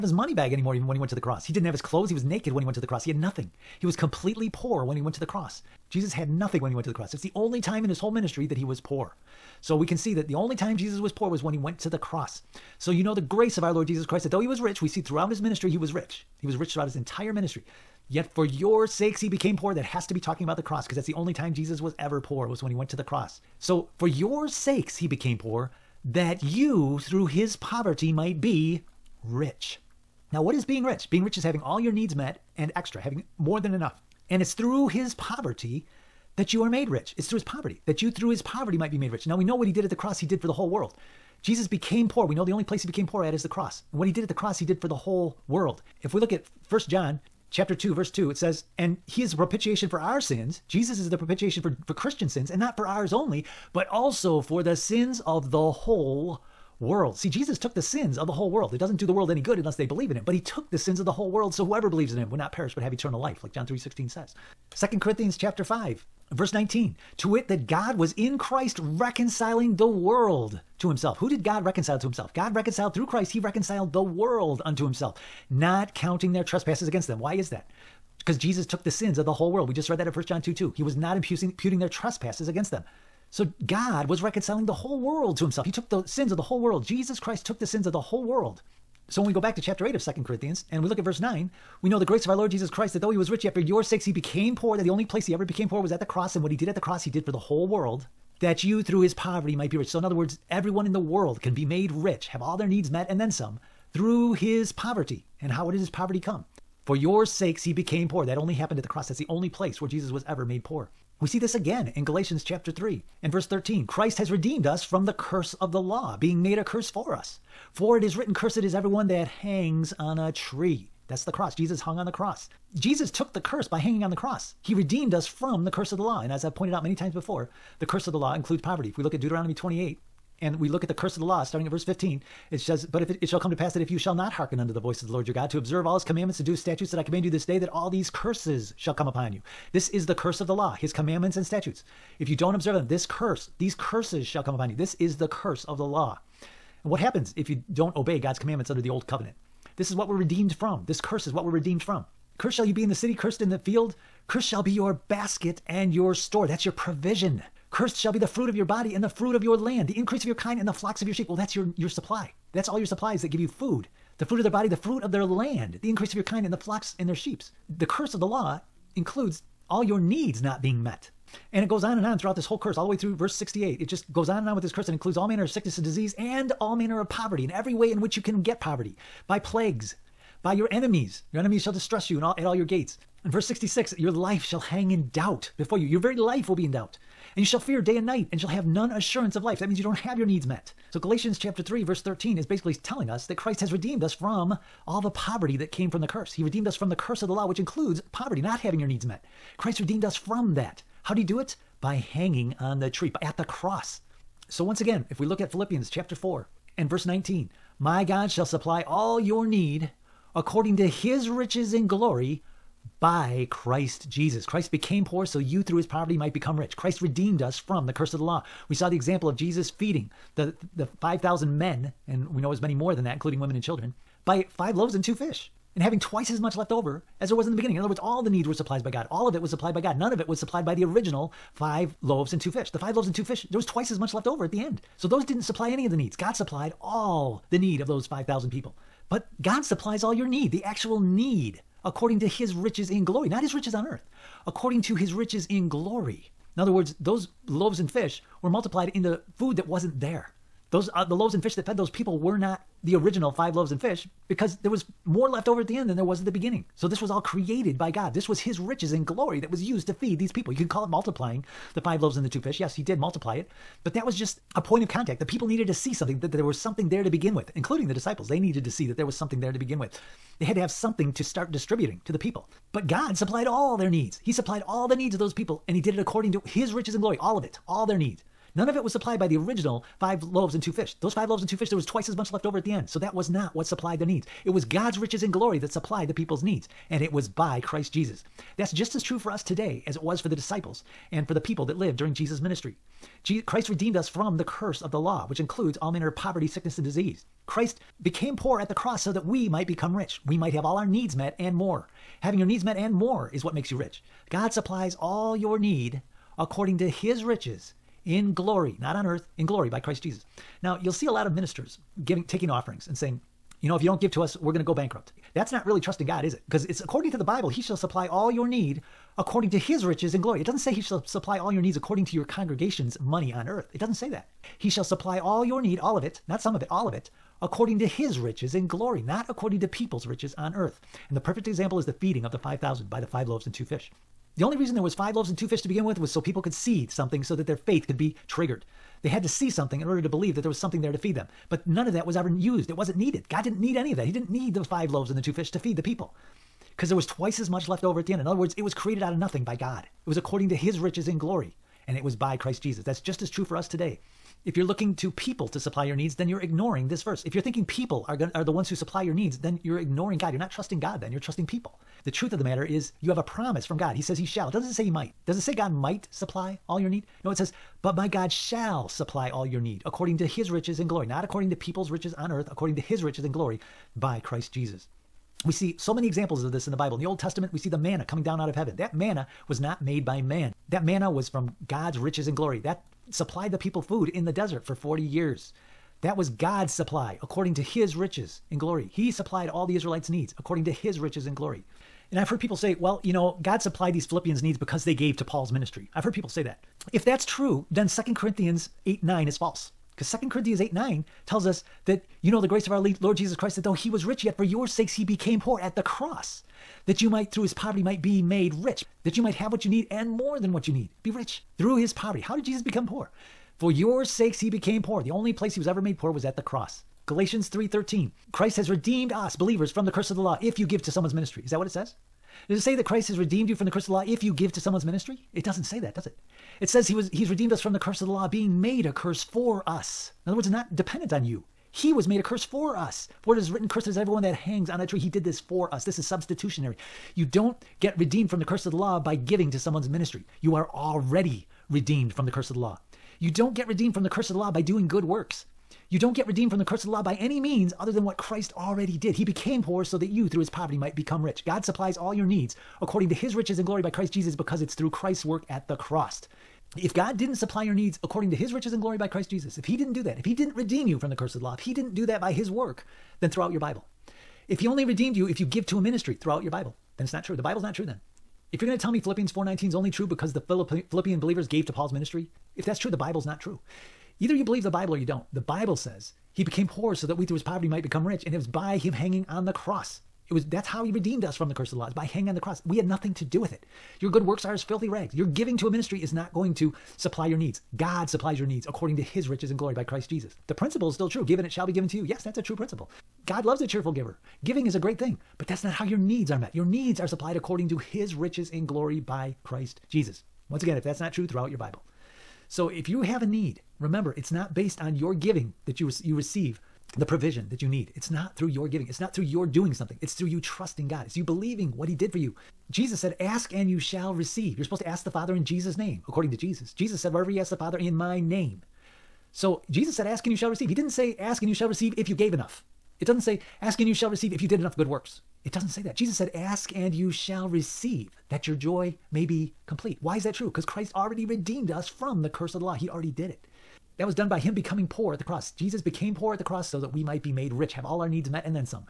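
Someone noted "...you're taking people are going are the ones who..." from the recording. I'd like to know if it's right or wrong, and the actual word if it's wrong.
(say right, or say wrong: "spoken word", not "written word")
wrong: "thinking", not "taking".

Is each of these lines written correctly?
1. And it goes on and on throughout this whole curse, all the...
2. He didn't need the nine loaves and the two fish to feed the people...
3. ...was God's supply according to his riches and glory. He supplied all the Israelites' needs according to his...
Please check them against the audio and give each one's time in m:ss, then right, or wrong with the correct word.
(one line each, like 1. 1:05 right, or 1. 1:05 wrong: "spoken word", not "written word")
1. 2:51 right
2. 5:44 wrong: "five", not "nine"
3. 6:26 right.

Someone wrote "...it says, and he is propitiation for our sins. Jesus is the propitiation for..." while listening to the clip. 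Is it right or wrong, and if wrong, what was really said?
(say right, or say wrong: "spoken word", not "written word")
right.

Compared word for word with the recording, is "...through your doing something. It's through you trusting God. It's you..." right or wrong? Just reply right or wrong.
right.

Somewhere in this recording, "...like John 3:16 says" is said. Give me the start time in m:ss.
1:03.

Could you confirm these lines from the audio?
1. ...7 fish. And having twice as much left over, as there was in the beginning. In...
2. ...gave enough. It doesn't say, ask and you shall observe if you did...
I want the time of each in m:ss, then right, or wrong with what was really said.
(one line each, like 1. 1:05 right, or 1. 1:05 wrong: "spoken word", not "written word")
1. 3:45 wrong: "2", not "7"
2. 8:42 wrong: "receive", not "observe".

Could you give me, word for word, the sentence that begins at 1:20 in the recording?
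He was not imputing, imputing their trespasses against them.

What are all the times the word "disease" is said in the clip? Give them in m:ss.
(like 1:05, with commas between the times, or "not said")
2:55, 4:56.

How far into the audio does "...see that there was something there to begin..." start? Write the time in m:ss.
4:28.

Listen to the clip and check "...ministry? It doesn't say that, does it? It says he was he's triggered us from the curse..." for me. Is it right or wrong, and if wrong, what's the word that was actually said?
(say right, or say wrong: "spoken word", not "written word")
wrong: "redeemed", not "triggered".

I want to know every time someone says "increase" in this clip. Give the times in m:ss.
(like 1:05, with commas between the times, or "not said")
2:39, 2:45.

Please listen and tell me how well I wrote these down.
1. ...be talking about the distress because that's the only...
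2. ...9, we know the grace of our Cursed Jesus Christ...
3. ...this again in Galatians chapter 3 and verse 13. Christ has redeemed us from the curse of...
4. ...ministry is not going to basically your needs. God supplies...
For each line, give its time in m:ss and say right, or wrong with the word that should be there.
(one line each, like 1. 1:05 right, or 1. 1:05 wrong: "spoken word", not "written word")
1. 0:20 wrong: "cross", not "distress"
2. 1:31 wrong: "Lord", not "Cursed"
3. 1:51 right
4. 8:05 wrong: "supply", not "basically".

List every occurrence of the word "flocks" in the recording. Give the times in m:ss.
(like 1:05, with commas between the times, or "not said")
2:40, 2:46.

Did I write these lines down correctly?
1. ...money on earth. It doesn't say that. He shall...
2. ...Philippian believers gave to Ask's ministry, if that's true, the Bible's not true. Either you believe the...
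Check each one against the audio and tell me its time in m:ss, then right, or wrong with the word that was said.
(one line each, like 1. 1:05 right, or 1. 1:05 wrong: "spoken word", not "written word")
1. 5:22 right
2. 7:50 wrong: "Paul", not "Ask".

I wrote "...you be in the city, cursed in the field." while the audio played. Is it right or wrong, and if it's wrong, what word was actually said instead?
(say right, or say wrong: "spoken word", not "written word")
right.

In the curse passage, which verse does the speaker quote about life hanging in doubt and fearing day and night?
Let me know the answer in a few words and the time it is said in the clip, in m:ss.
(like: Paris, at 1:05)
Verse 66, at 3:03.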